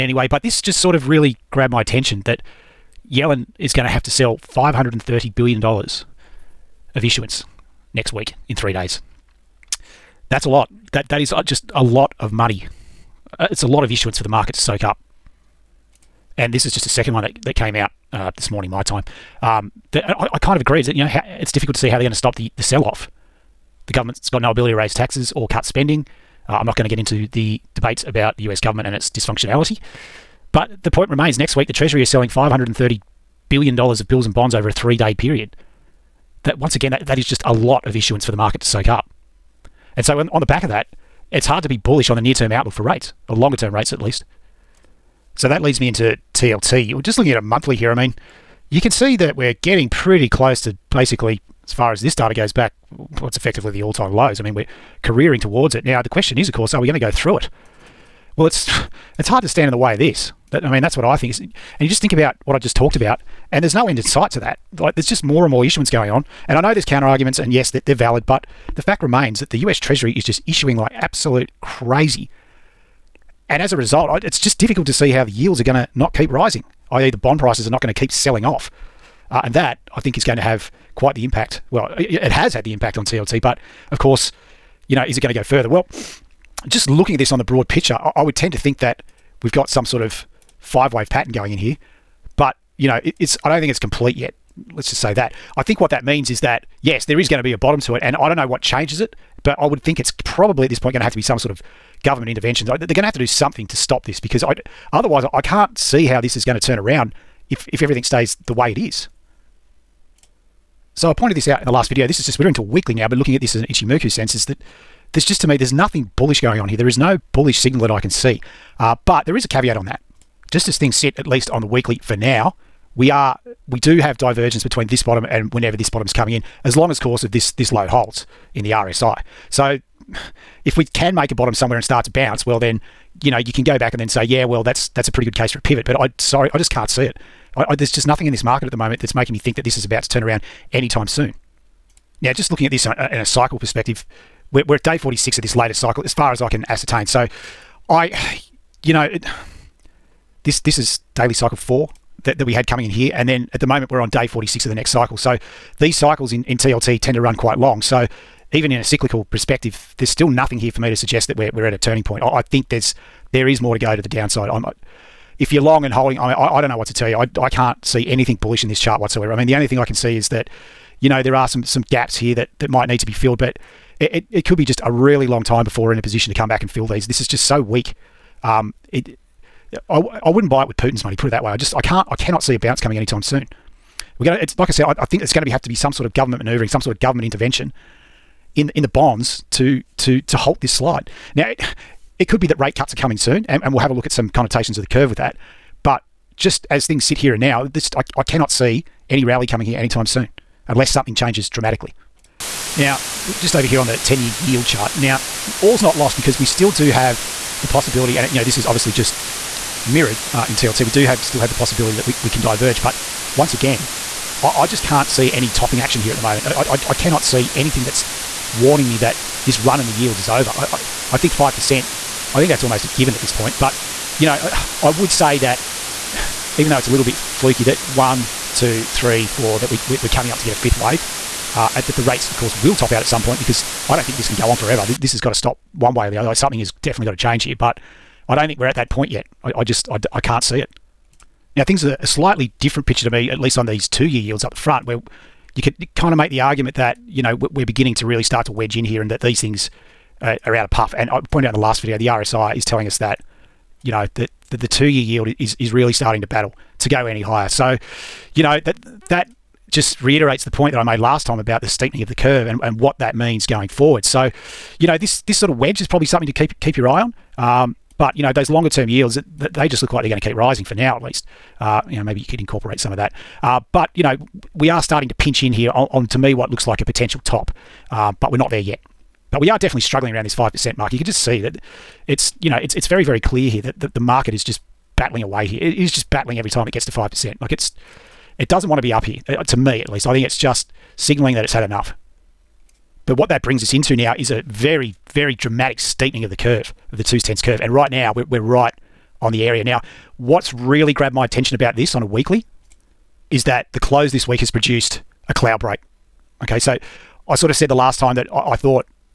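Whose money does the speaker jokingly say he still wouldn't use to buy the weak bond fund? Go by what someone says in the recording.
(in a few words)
Putin.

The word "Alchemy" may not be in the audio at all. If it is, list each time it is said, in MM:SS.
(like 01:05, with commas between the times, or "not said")
not said.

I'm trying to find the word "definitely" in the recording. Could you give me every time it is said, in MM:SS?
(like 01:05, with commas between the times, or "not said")
03:56, 04:39.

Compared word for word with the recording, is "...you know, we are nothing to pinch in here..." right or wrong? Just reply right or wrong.
wrong.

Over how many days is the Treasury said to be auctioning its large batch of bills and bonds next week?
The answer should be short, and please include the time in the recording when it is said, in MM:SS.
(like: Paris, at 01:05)
3, at 00:34.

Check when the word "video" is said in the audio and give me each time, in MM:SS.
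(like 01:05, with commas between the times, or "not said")
01:51, 04:11.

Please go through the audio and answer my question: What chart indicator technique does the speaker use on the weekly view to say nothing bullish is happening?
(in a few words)
Ichimoku.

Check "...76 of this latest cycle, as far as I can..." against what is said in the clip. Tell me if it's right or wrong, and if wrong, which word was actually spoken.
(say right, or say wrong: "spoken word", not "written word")
wrong: "46", not "76".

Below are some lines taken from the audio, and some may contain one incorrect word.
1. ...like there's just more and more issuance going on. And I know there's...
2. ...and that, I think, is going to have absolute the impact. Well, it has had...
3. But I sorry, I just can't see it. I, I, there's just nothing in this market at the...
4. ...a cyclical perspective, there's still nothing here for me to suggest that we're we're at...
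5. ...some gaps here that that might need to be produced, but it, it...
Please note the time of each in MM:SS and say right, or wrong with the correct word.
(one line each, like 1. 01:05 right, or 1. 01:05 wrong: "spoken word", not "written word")
1. 01:04 right
2. 01:19 wrong: "quite", not "absolute"
3. 02:15 right
4. 02:38 right
5. 02:51 wrong: "filled", not "produced".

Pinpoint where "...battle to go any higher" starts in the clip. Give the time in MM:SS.
04:16.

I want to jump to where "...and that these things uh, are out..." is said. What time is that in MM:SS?
04:09.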